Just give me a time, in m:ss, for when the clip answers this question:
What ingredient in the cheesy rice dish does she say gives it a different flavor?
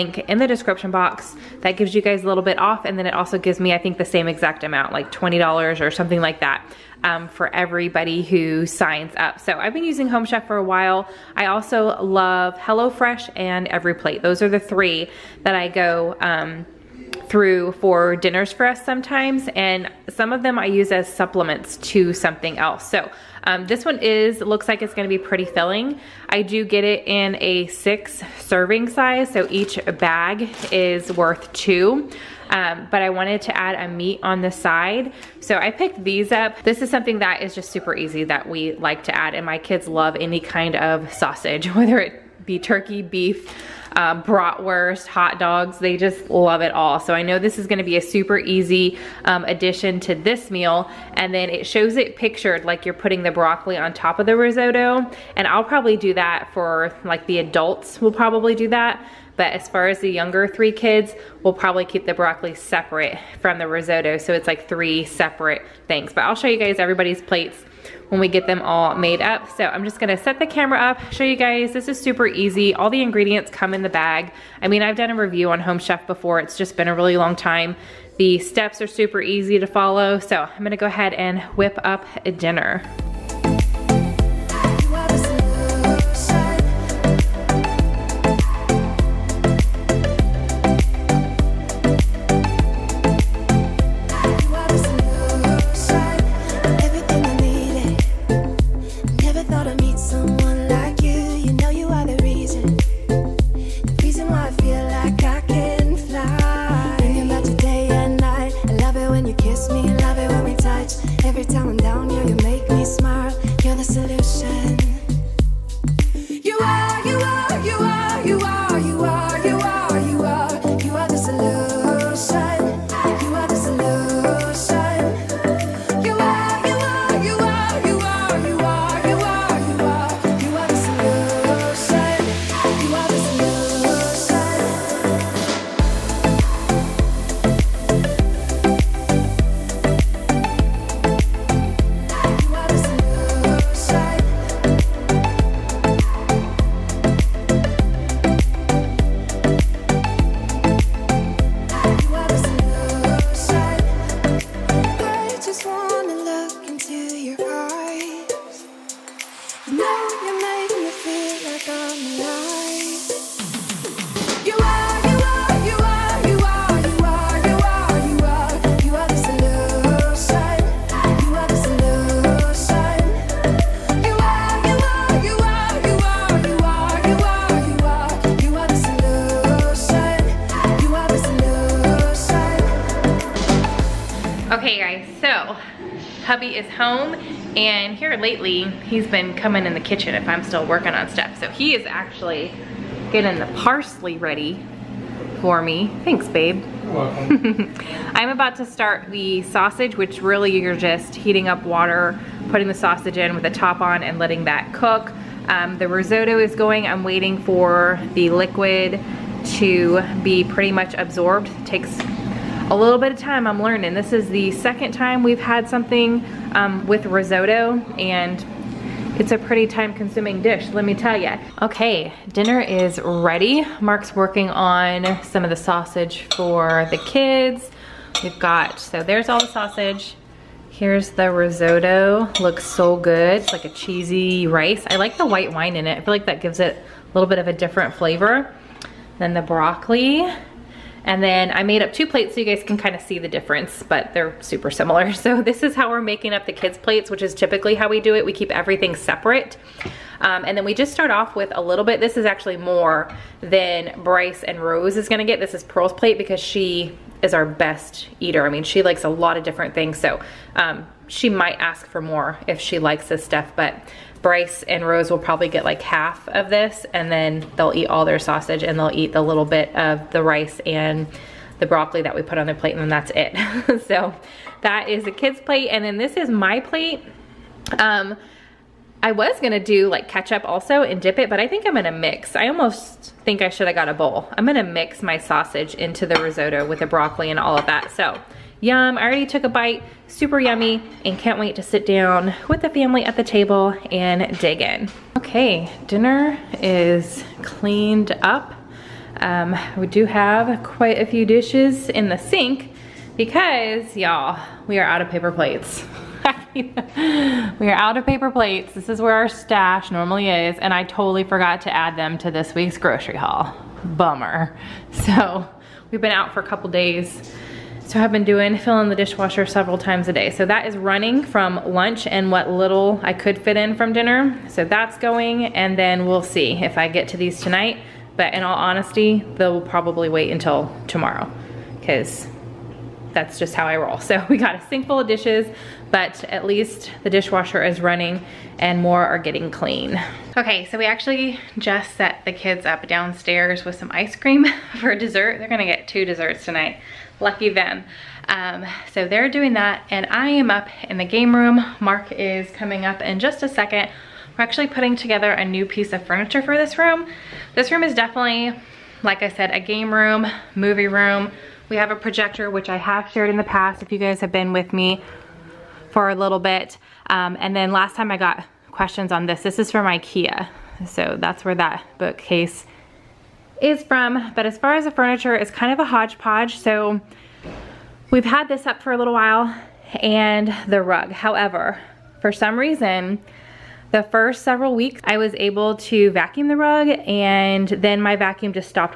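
3:55.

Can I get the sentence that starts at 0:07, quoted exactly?
Um, for everybody who signs up.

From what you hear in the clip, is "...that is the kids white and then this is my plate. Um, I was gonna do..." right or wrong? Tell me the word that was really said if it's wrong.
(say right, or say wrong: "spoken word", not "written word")
wrong: "plate", not "white".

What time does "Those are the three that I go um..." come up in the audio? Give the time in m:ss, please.
0:14.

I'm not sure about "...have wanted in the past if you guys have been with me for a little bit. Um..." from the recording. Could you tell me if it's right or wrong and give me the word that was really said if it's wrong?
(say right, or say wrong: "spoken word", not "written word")
wrong: "shared", not "wanted".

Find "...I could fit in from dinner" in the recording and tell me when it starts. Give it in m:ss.
5:23.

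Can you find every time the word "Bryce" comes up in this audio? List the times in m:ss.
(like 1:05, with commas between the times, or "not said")
4:14, 4:24.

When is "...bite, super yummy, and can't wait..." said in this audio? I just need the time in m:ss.
4:49.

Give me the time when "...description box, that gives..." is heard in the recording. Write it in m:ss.
0:00.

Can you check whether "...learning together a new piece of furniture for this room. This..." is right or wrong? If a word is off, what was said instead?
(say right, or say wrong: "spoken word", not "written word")
wrong: "putting", not "learning".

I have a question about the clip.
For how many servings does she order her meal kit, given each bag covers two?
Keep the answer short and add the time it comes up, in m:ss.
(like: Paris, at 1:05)
6, at 0:27.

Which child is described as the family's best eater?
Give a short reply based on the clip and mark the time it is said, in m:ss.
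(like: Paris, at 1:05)
Pearl, at 4:15.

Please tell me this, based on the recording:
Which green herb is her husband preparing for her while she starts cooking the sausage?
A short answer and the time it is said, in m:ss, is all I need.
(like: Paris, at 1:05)
Parsley, at 3:13.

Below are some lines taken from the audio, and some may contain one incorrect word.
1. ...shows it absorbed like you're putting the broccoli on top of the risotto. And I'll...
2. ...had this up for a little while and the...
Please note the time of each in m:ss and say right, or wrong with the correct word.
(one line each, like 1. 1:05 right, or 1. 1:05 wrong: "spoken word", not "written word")
1. 0:51 wrong: "pictured", not "absorbed"
2. 6:18 right.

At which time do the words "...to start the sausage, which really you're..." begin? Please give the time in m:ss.
3:18.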